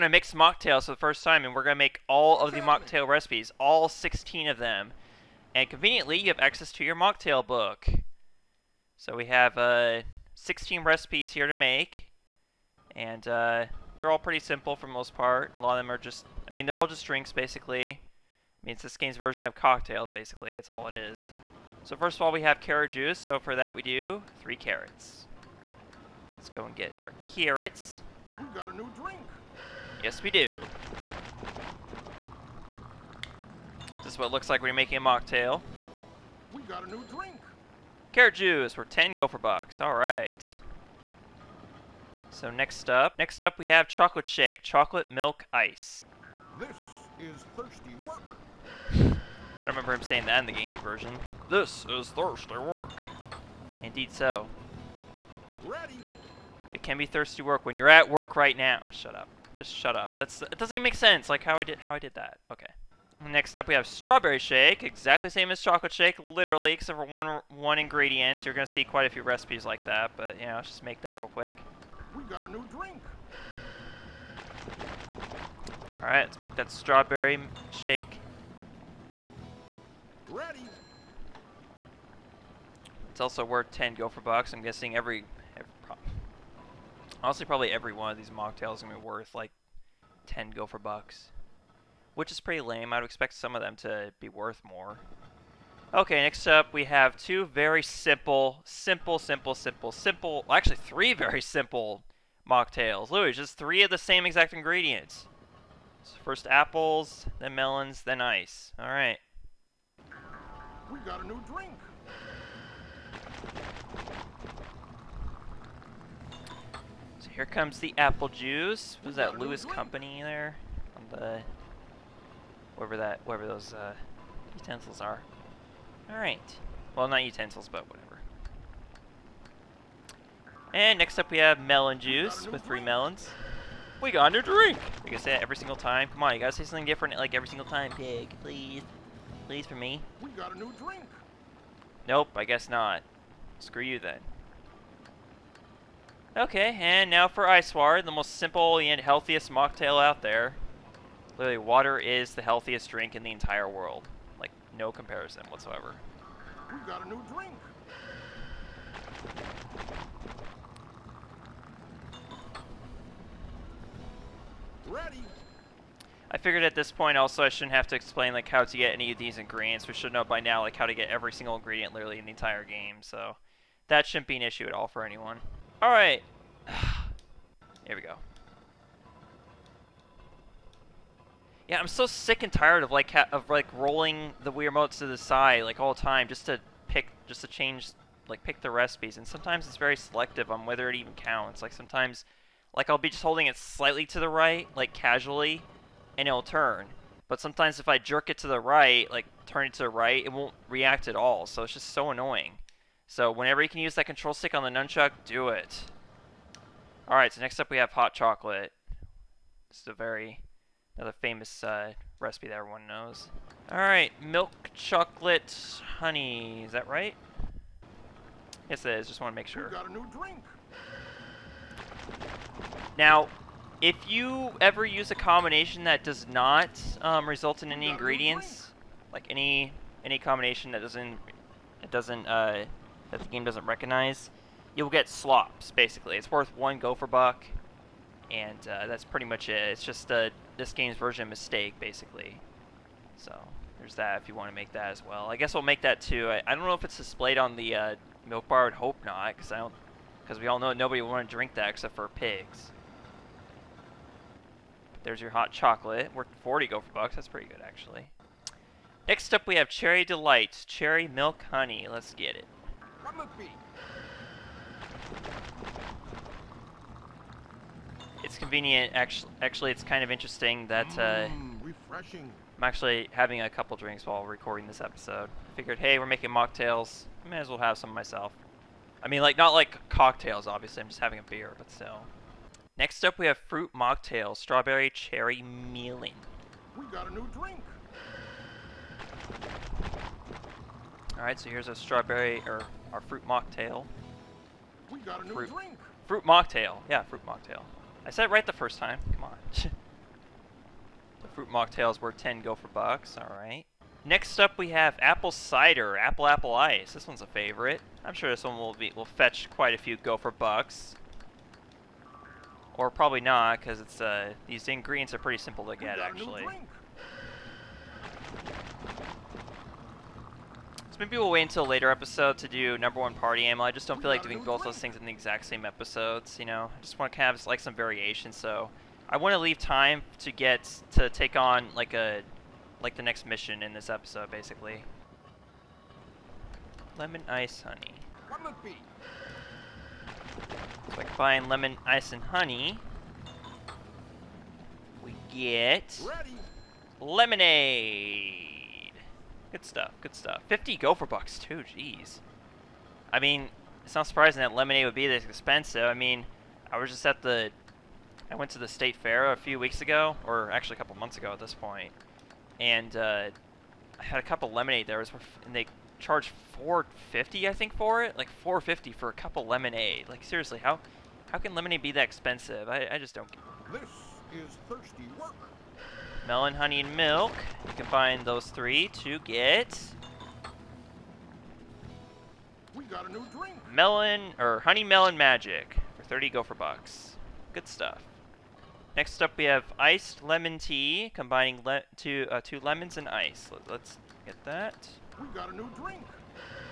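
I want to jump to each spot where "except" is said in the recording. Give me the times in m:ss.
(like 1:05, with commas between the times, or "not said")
1:06, 4:11.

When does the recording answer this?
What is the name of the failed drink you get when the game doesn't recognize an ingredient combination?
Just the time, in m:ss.
3:55.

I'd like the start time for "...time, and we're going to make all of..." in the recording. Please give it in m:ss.
0:01.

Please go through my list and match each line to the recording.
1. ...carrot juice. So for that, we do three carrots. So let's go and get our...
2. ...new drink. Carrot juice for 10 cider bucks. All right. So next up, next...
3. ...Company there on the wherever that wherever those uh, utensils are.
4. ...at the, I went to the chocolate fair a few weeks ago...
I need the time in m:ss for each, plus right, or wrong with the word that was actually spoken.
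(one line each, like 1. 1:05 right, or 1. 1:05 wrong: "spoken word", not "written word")
1. 0:22 right
2. 0:36 wrong: "gopher", not "cider"
3. 1:59 right
4. 5:57 wrong: "state", not "chocolate".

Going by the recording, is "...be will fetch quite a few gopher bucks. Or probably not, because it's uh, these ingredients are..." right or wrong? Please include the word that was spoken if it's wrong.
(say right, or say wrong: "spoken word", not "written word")
right.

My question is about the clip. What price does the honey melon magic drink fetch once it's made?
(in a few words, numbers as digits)
30 gopher bucks.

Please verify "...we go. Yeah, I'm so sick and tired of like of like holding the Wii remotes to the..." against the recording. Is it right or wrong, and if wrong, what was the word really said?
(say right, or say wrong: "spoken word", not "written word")
wrong: "rolling", not "holding".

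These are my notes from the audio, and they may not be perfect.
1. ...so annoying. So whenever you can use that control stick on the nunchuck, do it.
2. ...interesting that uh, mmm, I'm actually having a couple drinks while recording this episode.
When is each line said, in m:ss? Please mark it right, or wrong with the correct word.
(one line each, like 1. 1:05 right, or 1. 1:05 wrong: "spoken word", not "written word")
1. 3:21 right
2. 4:30 right.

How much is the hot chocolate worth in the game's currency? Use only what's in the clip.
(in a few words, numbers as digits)
40 gopher bucks.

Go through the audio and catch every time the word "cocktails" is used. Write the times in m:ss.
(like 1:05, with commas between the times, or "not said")
0:19, 4:39.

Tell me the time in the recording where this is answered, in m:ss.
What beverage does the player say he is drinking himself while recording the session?
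4:41.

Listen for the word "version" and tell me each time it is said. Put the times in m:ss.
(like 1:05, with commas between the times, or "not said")
0:19, 0:50, 4:00.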